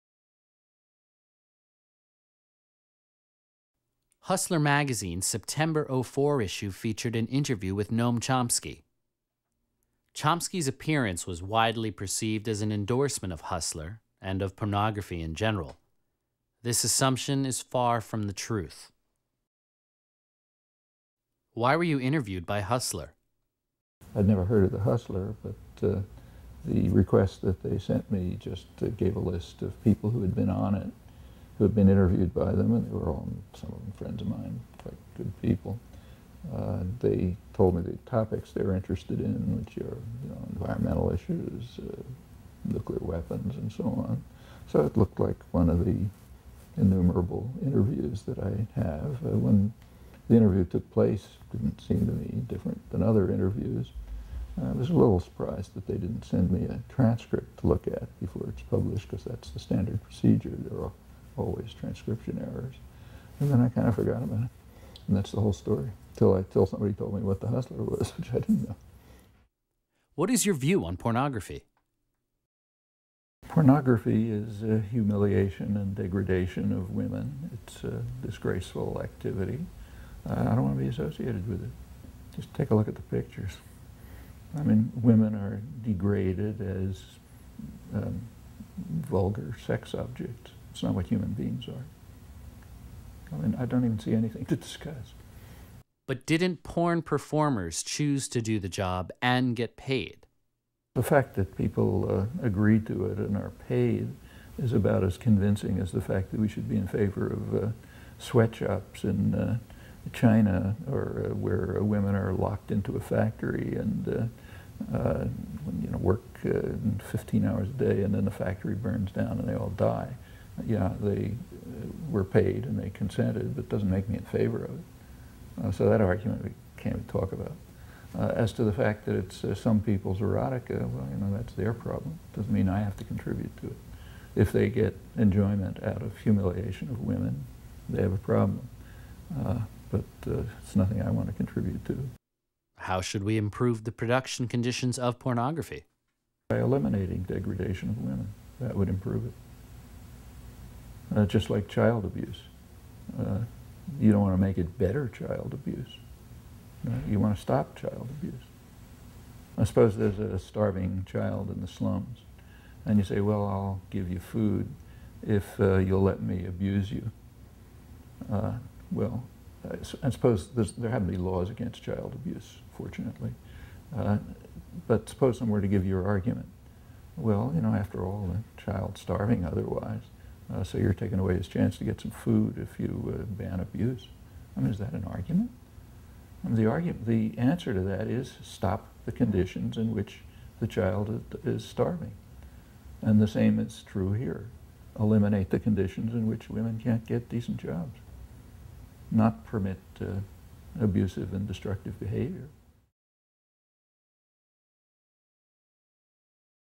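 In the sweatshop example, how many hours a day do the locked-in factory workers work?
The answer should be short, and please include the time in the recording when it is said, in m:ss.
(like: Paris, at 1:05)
15, at 1:56.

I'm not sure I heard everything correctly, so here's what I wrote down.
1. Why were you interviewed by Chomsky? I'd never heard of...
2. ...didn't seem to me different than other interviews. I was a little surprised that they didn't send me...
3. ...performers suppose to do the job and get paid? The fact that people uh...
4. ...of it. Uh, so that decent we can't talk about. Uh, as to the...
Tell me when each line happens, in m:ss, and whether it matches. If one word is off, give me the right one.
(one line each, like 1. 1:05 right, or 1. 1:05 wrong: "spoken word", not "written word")
1. 0:21 wrong: "Hustler", not "Chomsky"
2. 0:51 right
3. 1:37 wrong: "choose", not "suppose"
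4. 2:04 wrong: "argument", not "decent".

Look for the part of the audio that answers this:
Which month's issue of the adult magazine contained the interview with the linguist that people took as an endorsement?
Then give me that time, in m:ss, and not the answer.
0:05.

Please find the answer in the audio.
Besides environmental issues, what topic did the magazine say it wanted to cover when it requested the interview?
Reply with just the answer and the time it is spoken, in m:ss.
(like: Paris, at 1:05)
nuclear weapons, at 0:42.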